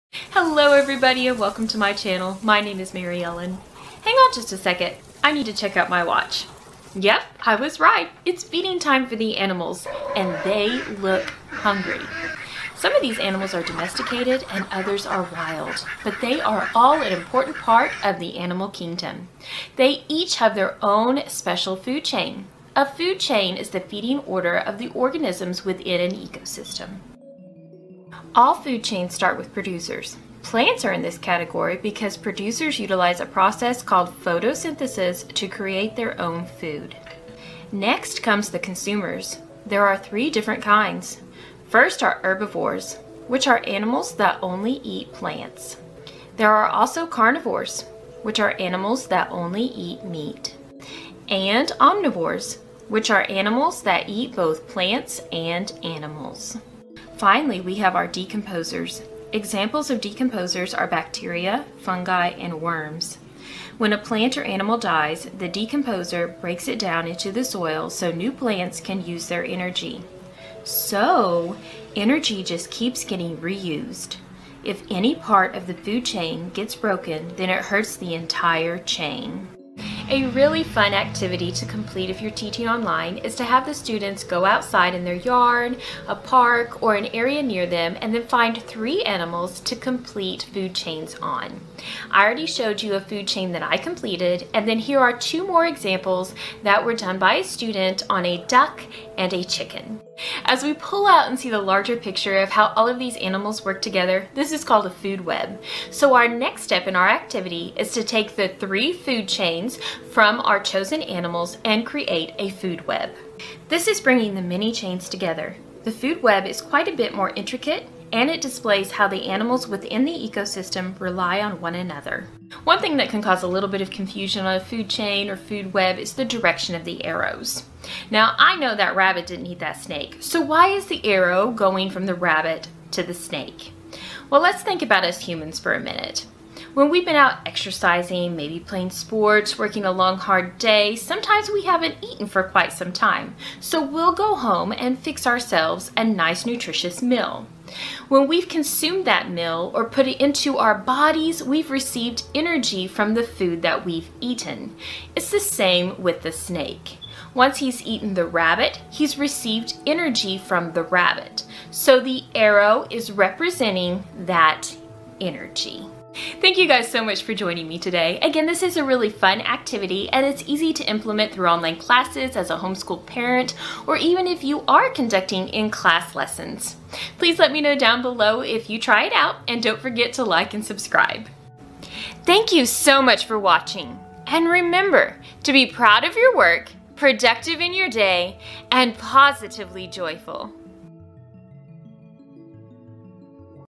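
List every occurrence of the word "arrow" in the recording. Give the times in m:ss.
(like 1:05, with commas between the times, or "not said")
2:07, 2:11, 2:42.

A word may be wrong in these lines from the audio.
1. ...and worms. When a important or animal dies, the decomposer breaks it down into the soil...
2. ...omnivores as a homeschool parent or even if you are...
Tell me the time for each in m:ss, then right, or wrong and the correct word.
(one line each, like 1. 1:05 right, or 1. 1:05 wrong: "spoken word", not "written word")
1. 1:02 wrong: "plant", not "important"
2. 2:51 wrong: "classes", not "omnivores".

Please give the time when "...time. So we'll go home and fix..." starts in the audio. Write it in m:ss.
2:22.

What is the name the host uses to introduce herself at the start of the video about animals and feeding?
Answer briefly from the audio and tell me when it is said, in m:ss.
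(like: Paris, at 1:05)
Mary Ellen, at 0:02.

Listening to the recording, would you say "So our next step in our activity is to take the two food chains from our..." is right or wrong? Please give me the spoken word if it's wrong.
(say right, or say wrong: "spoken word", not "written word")
wrong: "three", not "two".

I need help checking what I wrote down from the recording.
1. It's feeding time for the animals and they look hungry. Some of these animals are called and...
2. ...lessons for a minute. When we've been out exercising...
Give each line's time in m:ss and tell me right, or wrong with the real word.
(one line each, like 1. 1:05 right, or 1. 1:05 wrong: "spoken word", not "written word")
1. 0:08 wrong: "domesticated", not "called"
2. 2:15 wrong: "humans", not "lessons".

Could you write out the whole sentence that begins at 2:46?
Thank you guys so much for joining me today.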